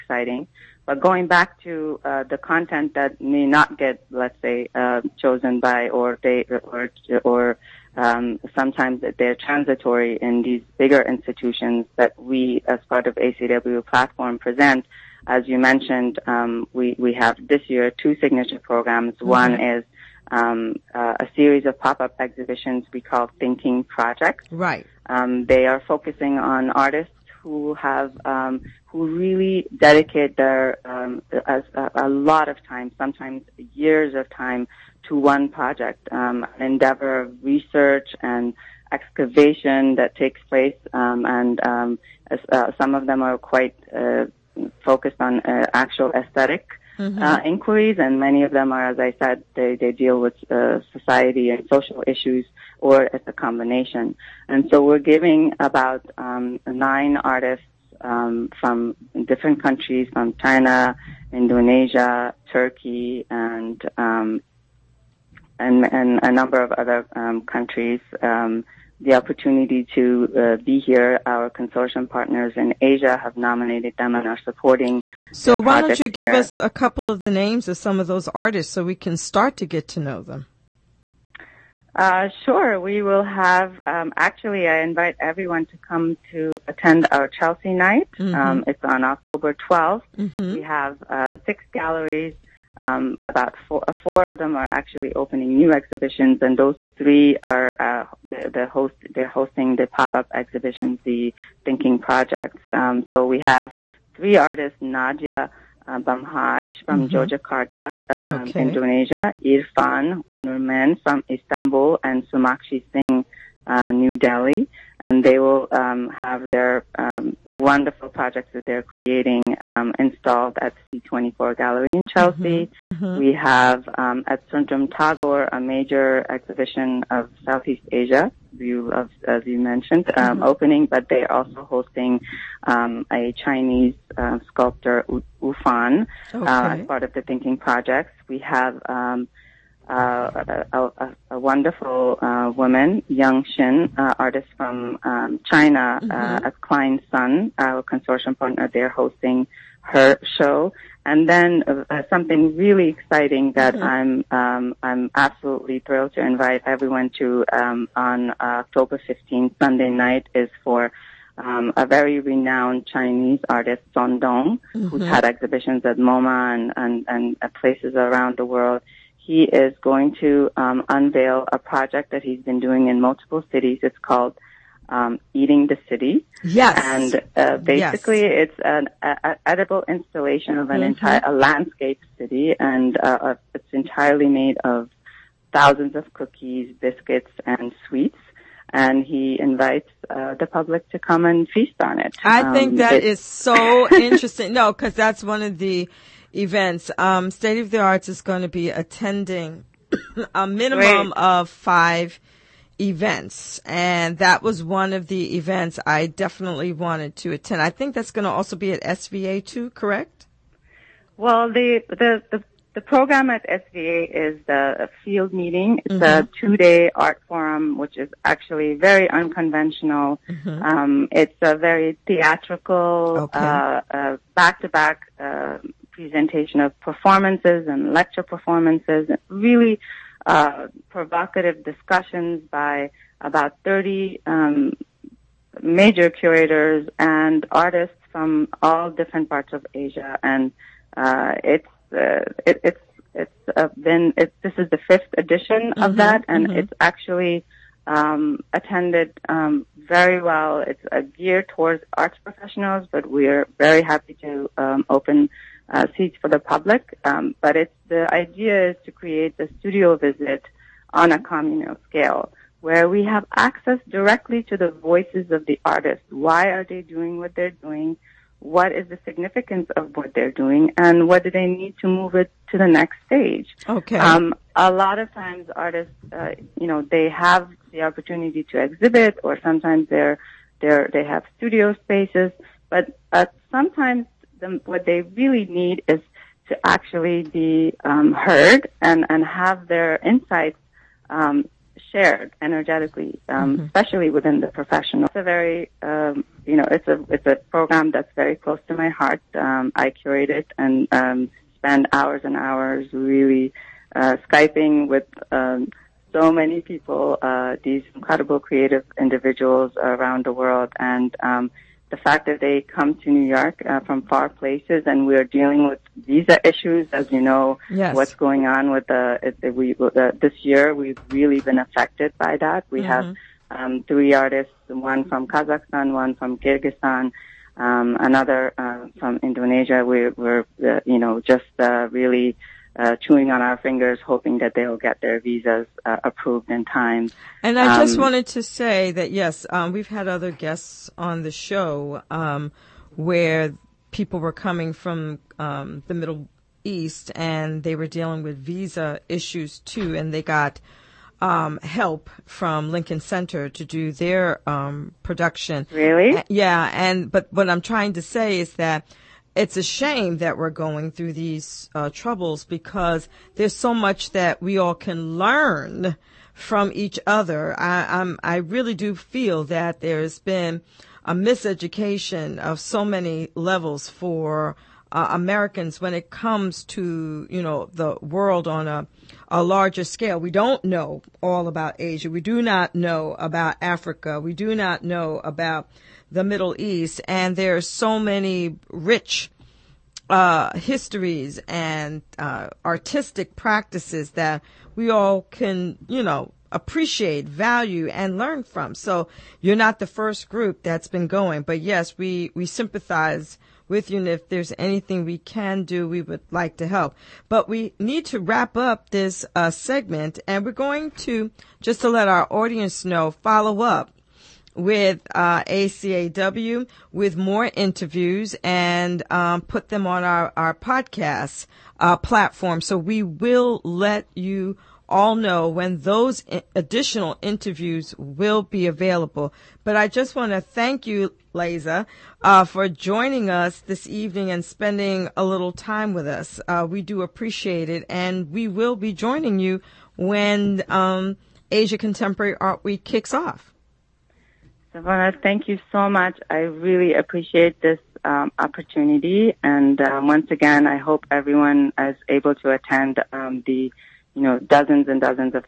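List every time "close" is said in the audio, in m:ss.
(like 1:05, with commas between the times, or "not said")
4:58.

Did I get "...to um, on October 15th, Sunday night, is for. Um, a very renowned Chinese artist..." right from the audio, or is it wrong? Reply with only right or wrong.
right.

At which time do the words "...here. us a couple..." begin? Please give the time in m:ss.
1:16.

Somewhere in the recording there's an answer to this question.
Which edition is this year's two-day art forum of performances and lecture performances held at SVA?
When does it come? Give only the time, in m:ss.
4:04.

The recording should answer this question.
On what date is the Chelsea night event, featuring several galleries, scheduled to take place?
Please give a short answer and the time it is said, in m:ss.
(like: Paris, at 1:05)
October 12, at 1:29.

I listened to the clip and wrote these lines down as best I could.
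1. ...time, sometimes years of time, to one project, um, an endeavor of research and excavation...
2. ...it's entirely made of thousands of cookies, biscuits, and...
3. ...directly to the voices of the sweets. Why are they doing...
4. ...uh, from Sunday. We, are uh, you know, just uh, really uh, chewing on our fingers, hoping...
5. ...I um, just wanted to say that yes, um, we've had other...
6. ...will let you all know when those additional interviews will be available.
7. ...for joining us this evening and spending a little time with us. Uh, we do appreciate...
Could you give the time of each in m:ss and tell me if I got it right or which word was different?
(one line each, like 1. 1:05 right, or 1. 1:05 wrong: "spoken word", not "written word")
1. 0:32 right
2. 3:03 right
3. 4:23 wrong: "artists", not "sweets"
4. 5:28 wrong: "Indonesia", not "Sunday"
5. 5:37 right
6. 7:03 right
7. 7:12 right.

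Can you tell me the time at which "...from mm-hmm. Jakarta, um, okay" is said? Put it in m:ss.
1:46.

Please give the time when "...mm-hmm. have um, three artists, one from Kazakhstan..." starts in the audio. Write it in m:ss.
5:22.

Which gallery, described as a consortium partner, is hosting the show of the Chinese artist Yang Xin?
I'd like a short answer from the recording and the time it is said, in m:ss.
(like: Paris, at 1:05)
Klein Sun, at 2:26.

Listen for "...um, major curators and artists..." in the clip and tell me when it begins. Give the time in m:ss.
3:54.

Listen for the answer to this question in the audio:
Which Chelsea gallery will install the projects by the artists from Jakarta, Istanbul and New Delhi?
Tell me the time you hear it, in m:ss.
2:00.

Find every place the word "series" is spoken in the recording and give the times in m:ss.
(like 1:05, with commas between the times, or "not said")
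0:21.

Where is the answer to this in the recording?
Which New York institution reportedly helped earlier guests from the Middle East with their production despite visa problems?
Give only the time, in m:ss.
5:52.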